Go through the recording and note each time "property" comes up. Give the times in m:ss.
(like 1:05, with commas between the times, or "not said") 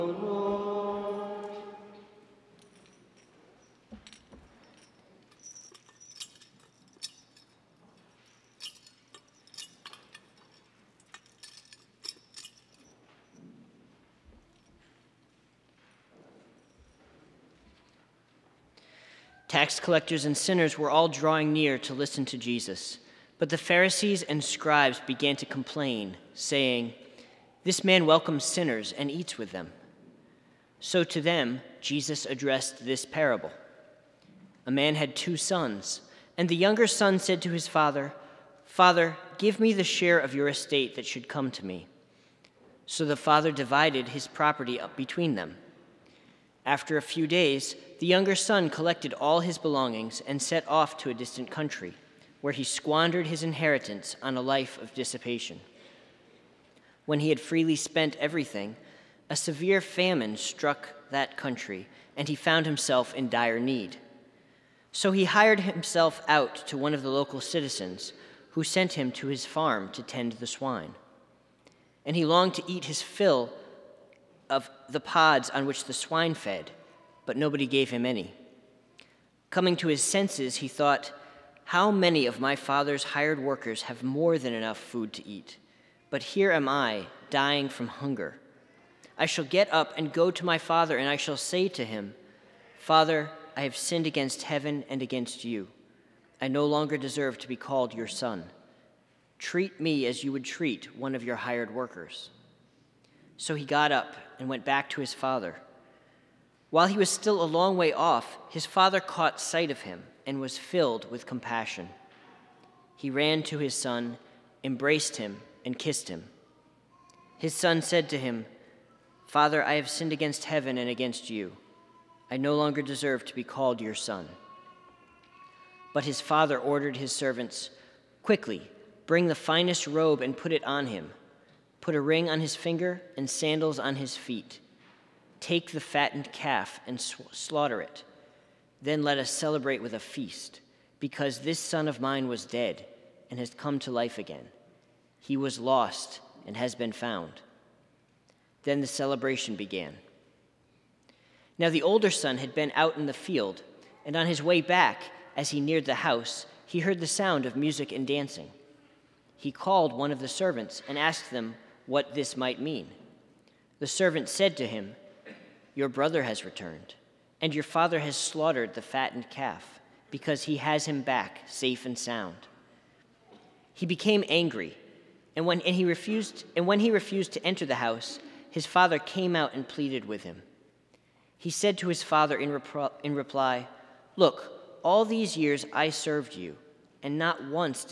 0:44.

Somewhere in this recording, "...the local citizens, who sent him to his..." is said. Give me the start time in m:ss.
1:07.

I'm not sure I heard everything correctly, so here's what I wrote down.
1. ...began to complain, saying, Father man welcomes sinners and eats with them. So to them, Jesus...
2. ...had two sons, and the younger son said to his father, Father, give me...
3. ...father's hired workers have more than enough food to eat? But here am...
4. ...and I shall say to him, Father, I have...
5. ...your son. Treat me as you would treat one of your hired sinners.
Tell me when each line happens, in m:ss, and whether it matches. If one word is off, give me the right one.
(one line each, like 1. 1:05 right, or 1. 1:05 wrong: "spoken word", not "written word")
1. 0:25 wrong: "This", not "Father"
2. 0:34 right
3. 1:22 right
4. 1:30 right
5. 1:37 wrong: "workers", not "sinners".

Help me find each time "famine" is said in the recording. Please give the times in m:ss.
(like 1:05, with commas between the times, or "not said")
0:59.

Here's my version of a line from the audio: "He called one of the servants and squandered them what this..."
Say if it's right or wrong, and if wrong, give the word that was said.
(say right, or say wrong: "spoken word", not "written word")
wrong: "asked", not "squandered".